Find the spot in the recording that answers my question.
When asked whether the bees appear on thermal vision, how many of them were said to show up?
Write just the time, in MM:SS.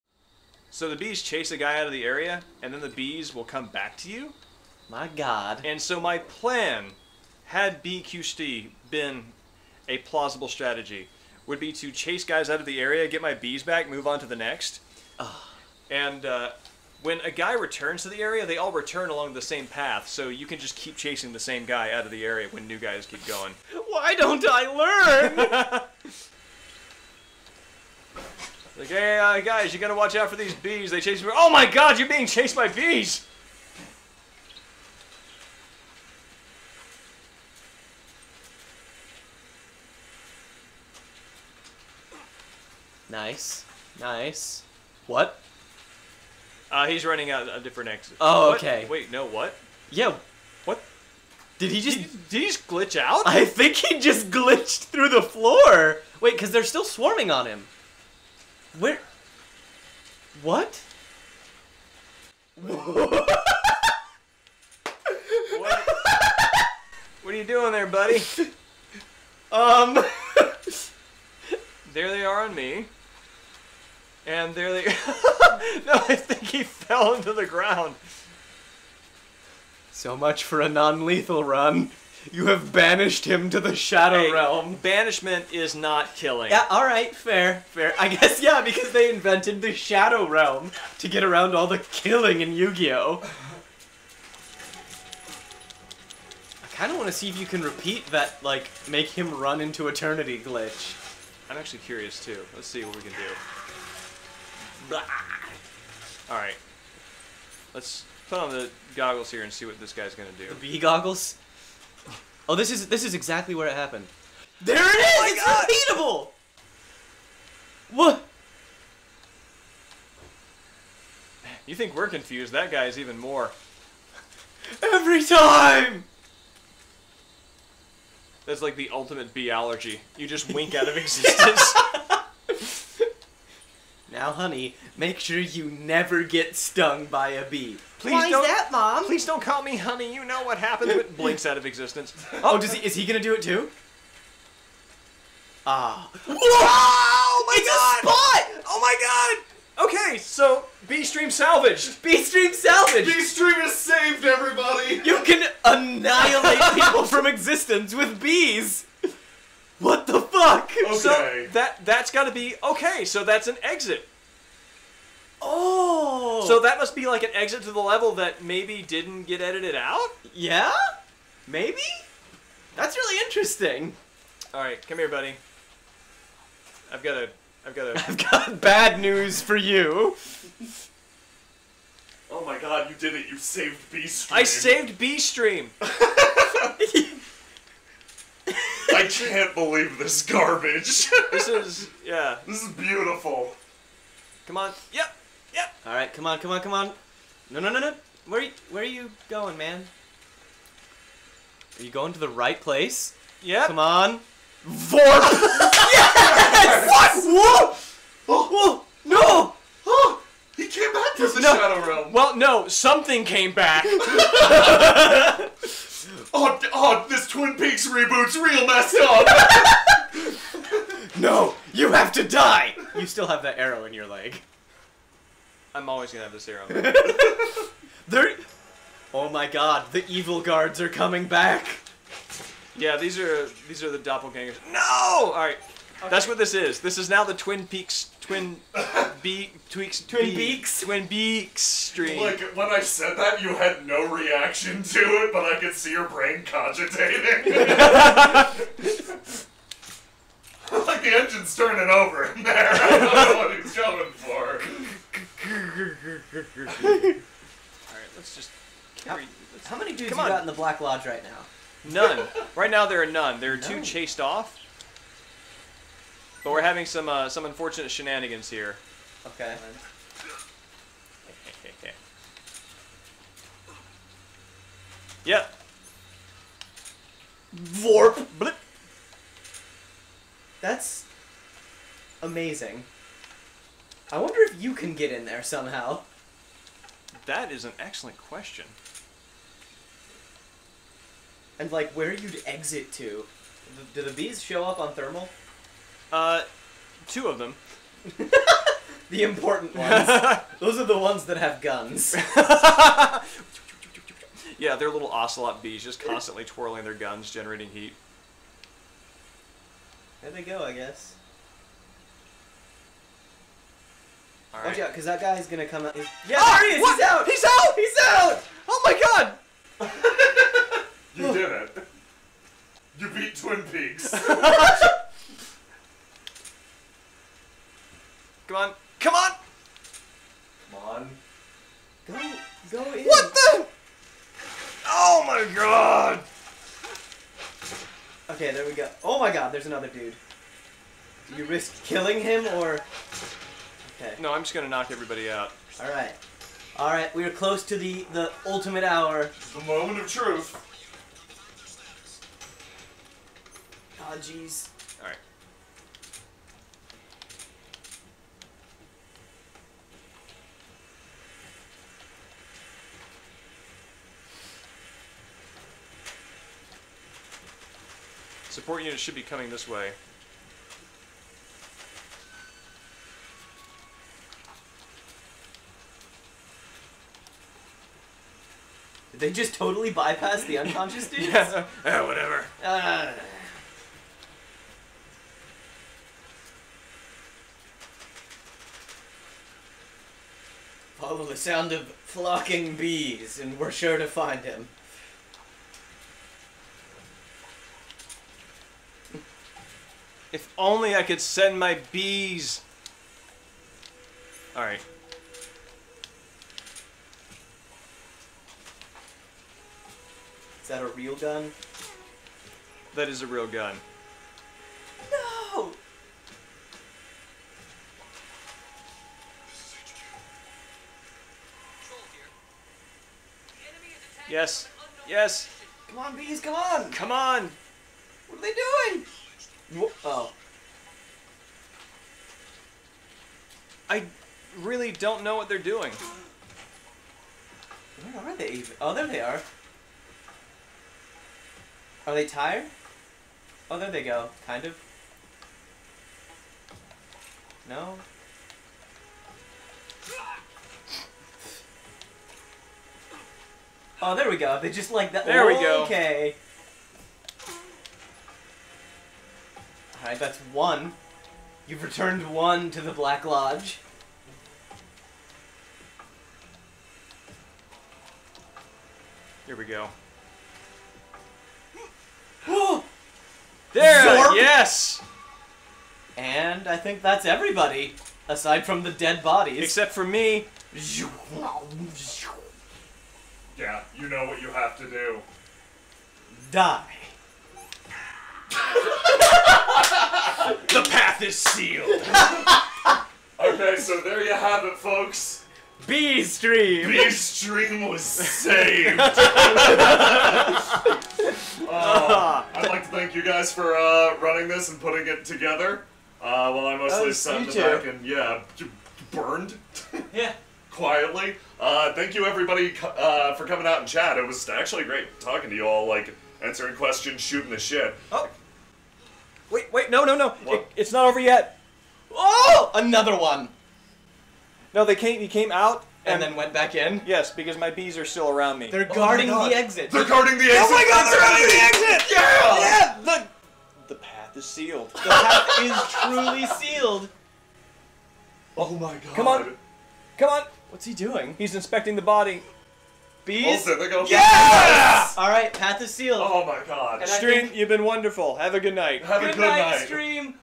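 04:57.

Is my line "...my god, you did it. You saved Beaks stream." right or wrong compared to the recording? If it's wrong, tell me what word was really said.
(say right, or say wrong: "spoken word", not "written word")
wrong: "Bee", not "Beaks".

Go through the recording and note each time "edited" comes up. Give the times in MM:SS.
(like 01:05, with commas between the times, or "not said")
02:49.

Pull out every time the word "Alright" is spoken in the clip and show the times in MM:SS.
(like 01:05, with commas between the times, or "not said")
04:15, 06:44, 07:40.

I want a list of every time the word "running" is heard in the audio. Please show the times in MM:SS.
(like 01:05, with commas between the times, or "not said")
00:47, 08:24.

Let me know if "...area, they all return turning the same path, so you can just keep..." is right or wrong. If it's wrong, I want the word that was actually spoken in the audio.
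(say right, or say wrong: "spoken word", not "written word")
wrong: "along", not "turning".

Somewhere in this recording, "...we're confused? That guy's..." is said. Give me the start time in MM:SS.
02:01.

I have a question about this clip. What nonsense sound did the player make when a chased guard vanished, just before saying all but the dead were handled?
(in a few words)
Zorb.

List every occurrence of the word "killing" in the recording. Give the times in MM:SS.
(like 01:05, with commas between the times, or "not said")
01:26, 01:31, 05:41.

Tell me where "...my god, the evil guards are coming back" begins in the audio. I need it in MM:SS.
03:49.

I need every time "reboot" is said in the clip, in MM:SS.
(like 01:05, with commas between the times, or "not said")
03:37.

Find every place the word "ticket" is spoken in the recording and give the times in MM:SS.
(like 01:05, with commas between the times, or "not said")
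not said.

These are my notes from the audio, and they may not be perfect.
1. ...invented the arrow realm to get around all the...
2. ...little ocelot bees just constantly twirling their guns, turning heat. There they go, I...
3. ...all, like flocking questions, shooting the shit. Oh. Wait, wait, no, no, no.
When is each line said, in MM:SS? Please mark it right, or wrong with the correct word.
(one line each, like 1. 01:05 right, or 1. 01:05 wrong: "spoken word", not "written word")
1. 01:29 wrong: "shadow", not "arrow"
2. 05:04 wrong: "generating", not "turning"
3. 08:35 wrong: "answering", not "flocking".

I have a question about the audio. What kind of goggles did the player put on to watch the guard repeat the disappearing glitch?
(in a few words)
V goggles.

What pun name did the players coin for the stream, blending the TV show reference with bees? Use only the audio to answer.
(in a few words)
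Twin Beaks.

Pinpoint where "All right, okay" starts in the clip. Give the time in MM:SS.
03:55.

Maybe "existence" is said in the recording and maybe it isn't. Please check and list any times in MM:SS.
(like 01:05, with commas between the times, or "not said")
02:10, 02:21, 02:37.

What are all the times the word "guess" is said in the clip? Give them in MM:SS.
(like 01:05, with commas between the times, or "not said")
01:28, 05:10.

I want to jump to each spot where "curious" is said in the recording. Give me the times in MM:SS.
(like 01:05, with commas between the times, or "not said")
01:41.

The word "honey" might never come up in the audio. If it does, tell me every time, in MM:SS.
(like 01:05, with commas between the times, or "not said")
02:14, 02:19.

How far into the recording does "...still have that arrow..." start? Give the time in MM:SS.
03:43.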